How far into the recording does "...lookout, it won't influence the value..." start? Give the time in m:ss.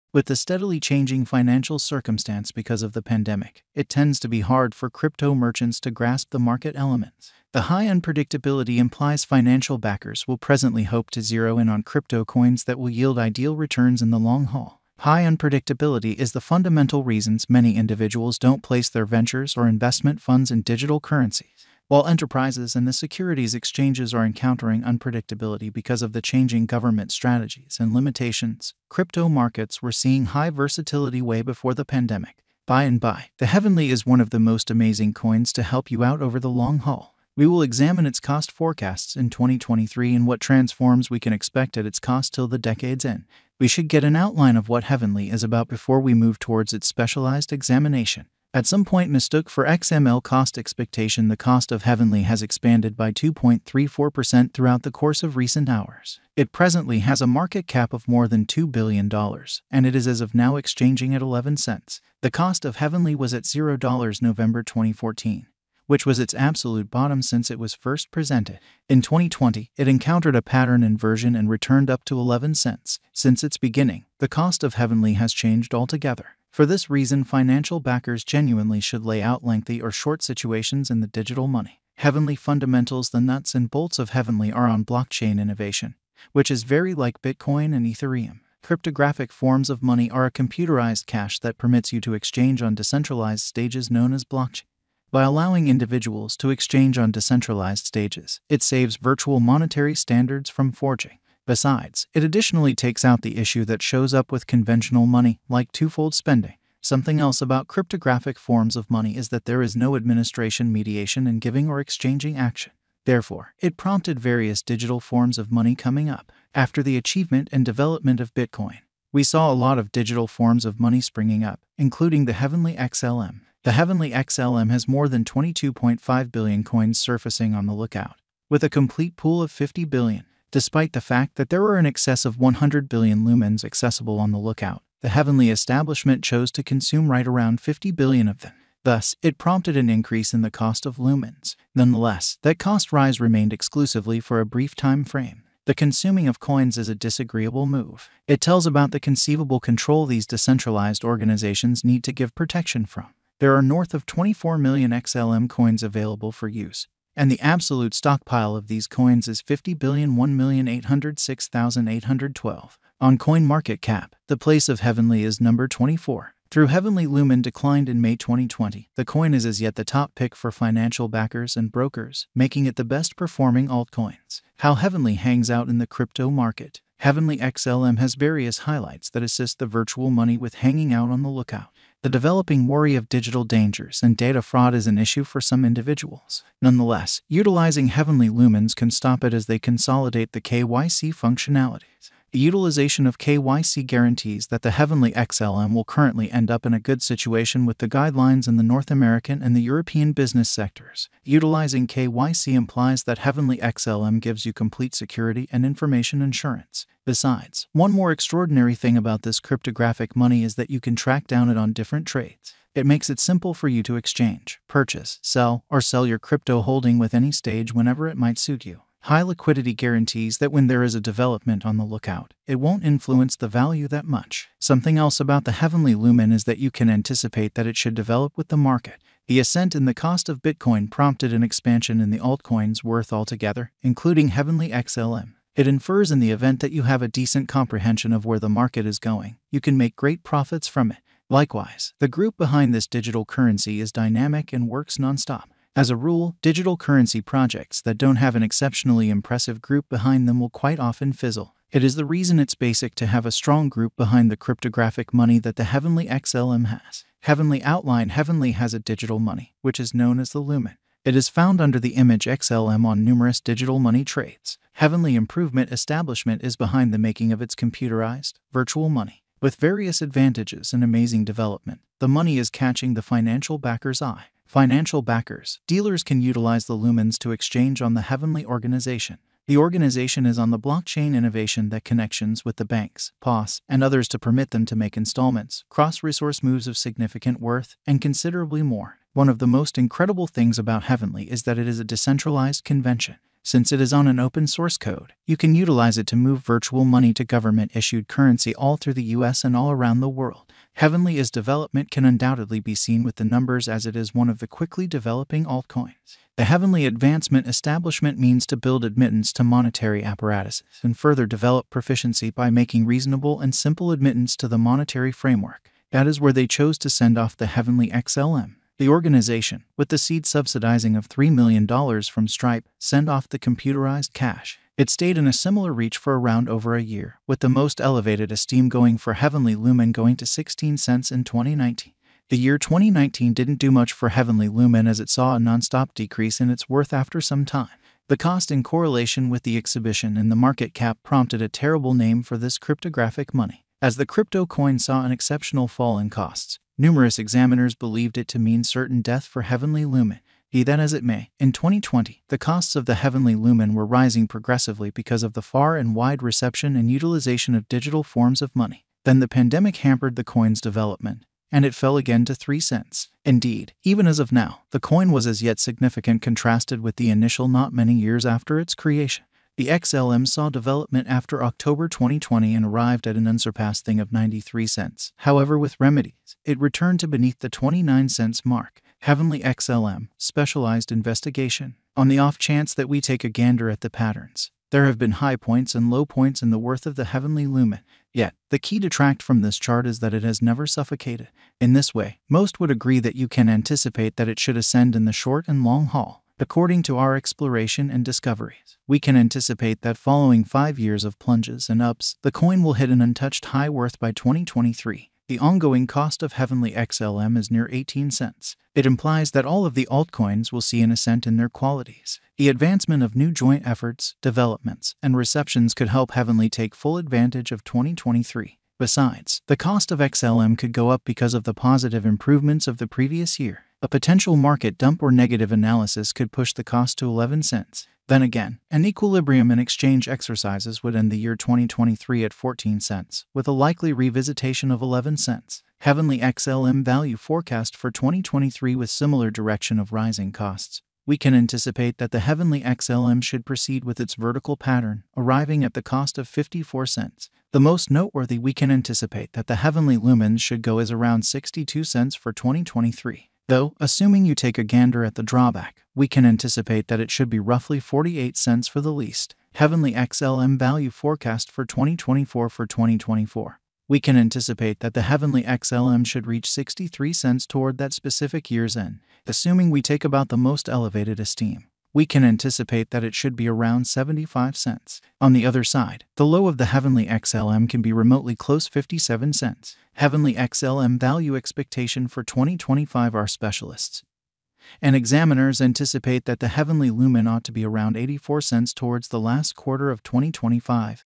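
3:41.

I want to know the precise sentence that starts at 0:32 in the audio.
By and by, the Heavenly is one of the most amazing coins to help you out over the long haul.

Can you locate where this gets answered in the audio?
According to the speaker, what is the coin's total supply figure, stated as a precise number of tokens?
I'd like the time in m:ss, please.
2:39.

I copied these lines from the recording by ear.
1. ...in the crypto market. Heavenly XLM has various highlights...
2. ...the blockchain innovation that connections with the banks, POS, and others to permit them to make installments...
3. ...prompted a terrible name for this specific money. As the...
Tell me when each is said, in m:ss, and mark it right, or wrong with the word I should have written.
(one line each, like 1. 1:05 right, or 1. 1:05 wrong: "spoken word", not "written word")
1. 2:55 right
2. 4:40 right
3. 5:41 wrong: "cryptographic", not "specific".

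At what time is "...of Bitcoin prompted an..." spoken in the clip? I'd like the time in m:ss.
3:50.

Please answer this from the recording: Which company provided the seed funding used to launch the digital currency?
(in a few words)
Stripe.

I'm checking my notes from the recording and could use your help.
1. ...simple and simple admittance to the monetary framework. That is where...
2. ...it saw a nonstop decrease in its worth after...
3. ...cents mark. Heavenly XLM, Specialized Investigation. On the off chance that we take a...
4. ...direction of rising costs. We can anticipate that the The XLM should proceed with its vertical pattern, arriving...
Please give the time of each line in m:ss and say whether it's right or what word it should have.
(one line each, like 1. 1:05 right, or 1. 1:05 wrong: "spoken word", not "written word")
1. 5:12 wrong: "reasonable", not "simple"
2. 5:34 right
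3. 6:18 right
4. 7:19 wrong: "Heavenly", not "The".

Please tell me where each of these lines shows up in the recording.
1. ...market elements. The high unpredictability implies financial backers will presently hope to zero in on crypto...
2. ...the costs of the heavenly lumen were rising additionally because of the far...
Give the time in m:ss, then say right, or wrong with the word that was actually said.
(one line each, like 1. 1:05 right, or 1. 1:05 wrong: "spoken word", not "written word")
1. 0:06 right
2. 5:52 wrong: "progressively", not "additionally".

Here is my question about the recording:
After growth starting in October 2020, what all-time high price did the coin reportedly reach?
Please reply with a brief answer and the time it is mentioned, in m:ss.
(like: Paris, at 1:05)
93 cents, at 6:14.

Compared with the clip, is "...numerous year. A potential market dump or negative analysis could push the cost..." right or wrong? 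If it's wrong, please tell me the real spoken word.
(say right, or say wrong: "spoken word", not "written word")
wrong: "previous", not "numerous".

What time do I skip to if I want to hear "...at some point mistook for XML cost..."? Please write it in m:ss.
0:48.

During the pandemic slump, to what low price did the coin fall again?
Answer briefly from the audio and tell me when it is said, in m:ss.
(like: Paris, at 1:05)
3 cents, at 6:02.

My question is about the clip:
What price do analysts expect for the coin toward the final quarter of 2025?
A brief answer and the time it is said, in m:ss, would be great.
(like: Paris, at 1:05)
84 cents, at 8:07.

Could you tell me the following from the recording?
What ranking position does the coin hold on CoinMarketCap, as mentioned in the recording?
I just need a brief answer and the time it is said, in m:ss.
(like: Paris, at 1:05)
24, at 2:45.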